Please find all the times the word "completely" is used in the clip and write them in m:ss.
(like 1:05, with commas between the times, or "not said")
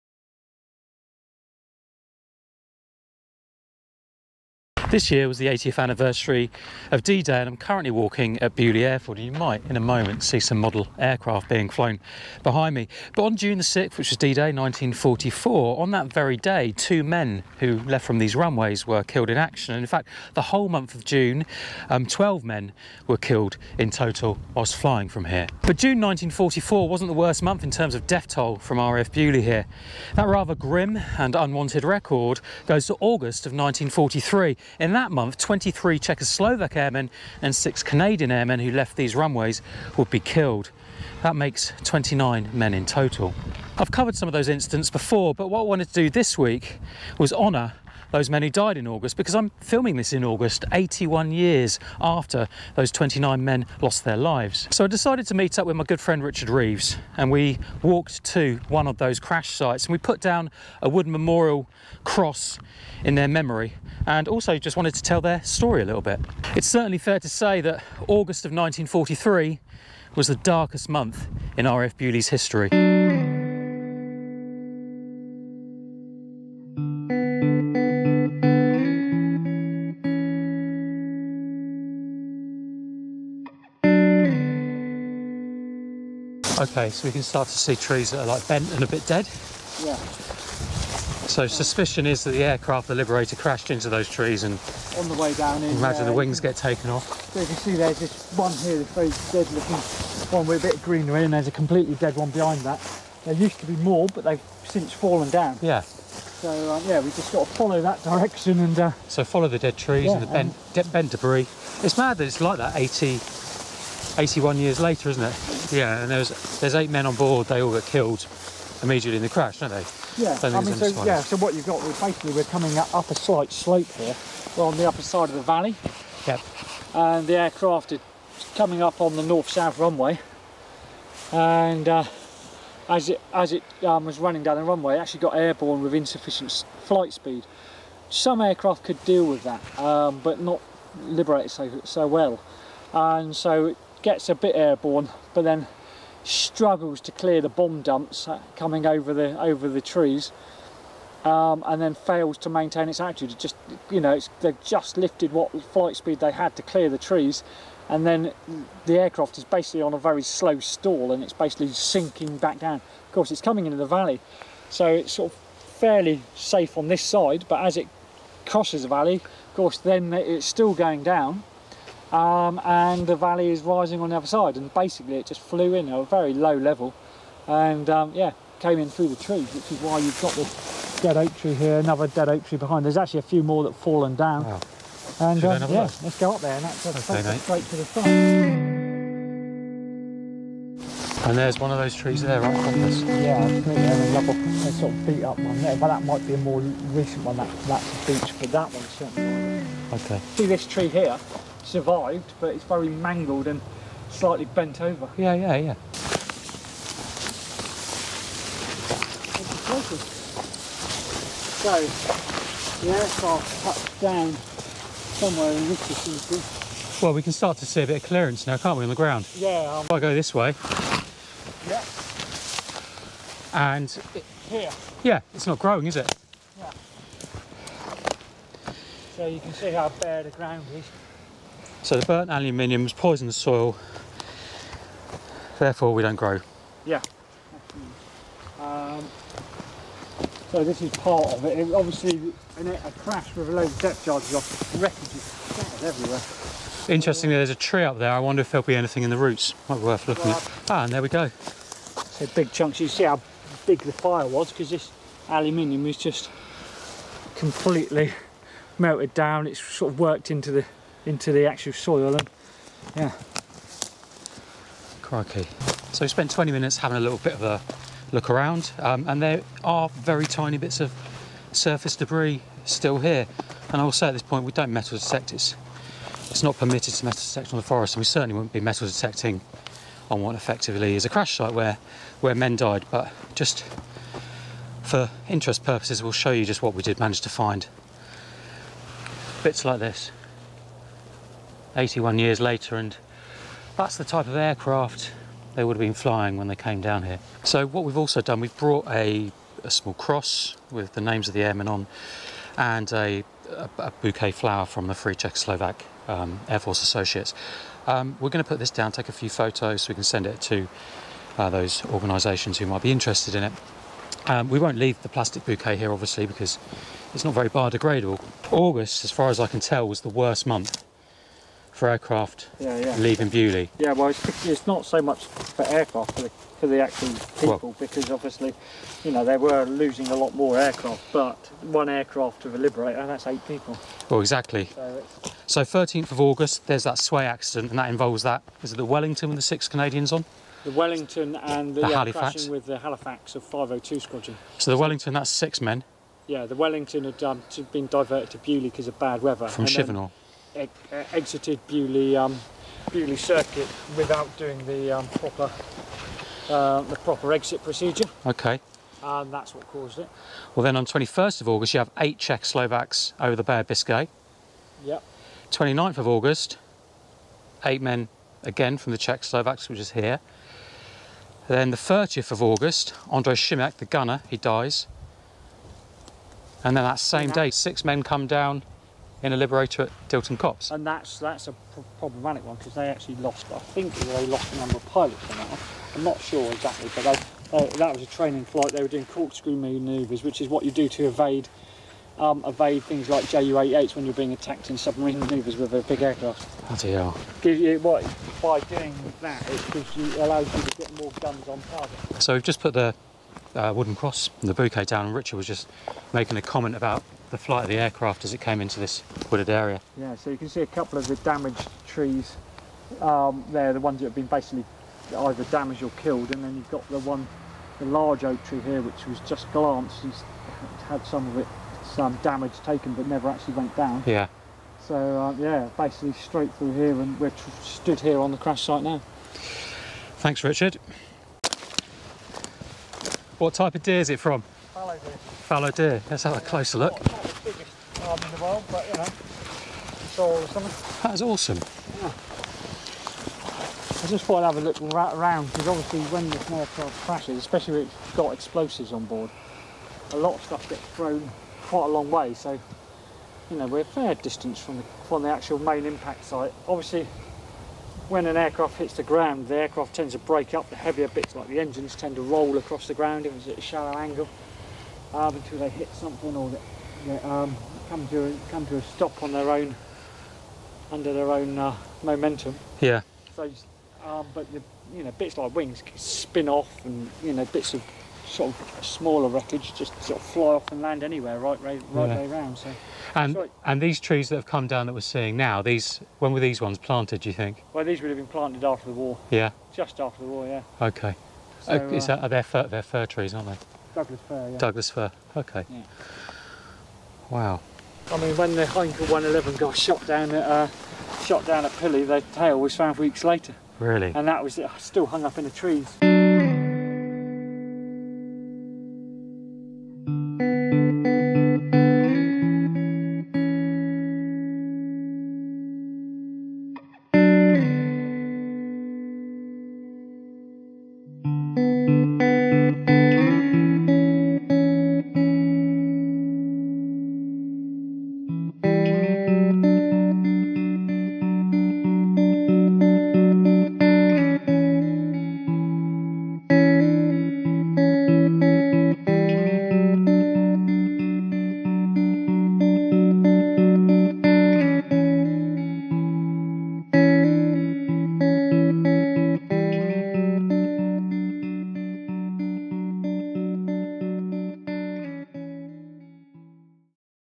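1:41, 4:17.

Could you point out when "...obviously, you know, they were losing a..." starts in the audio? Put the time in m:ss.
5:28.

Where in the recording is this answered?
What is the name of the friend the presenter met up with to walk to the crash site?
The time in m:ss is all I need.
0:56.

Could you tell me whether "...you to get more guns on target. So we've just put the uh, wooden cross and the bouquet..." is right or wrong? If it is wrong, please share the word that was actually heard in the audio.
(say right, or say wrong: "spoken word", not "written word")
right.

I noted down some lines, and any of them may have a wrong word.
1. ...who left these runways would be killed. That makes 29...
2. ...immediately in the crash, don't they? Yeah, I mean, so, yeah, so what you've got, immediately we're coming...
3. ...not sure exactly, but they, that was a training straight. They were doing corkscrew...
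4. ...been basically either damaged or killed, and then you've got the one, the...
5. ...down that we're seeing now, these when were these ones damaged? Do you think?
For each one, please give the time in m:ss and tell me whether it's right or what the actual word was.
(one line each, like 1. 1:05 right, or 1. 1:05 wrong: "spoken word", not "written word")
1. 0:38 right
2. 1:58 wrong: "basically", not "immediately"
3. 6:26 wrong: "flight", not "straight"
4. 6:54 right
5. 8:04 wrong: "planted", not "damaged".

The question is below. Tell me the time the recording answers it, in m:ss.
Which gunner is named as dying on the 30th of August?
6:13.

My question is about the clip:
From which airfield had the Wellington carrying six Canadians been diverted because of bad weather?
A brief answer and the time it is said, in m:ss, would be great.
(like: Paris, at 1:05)
Chivenor, at 5:49.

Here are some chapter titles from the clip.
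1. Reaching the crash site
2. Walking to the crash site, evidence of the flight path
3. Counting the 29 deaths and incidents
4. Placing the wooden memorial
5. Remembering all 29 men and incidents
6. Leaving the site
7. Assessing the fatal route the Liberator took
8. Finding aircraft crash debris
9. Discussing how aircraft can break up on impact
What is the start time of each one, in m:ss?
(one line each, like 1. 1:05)
1. 3:26
2. 1:13
3. 5:19
4. 5:00
5. 8:37
6. 8:18
7. 6:42
8. 4:10
9. 7:09.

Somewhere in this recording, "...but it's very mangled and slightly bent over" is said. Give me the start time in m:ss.
3:22.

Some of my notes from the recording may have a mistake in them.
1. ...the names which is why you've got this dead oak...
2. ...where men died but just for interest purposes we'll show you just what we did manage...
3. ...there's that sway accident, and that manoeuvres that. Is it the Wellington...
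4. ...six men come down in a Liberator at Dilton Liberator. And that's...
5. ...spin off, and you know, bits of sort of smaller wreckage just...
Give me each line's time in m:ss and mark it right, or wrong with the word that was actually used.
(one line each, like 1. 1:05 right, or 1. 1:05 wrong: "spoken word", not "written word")
1. 2:59 wrong: "trees", not "names"
2. 4:42 right
3. 5:36 wrong: "involves", not "manoeuvres"
4. 6:17 wrong: "Copse", not "Liberator"
5. 7:55 right.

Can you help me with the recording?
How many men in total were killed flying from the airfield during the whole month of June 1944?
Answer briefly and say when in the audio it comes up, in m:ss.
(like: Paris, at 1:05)
12, at 0:22.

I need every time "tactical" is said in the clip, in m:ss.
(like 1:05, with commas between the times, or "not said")
not said.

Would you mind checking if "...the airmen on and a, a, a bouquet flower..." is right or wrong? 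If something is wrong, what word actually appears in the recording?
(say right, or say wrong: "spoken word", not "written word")
right.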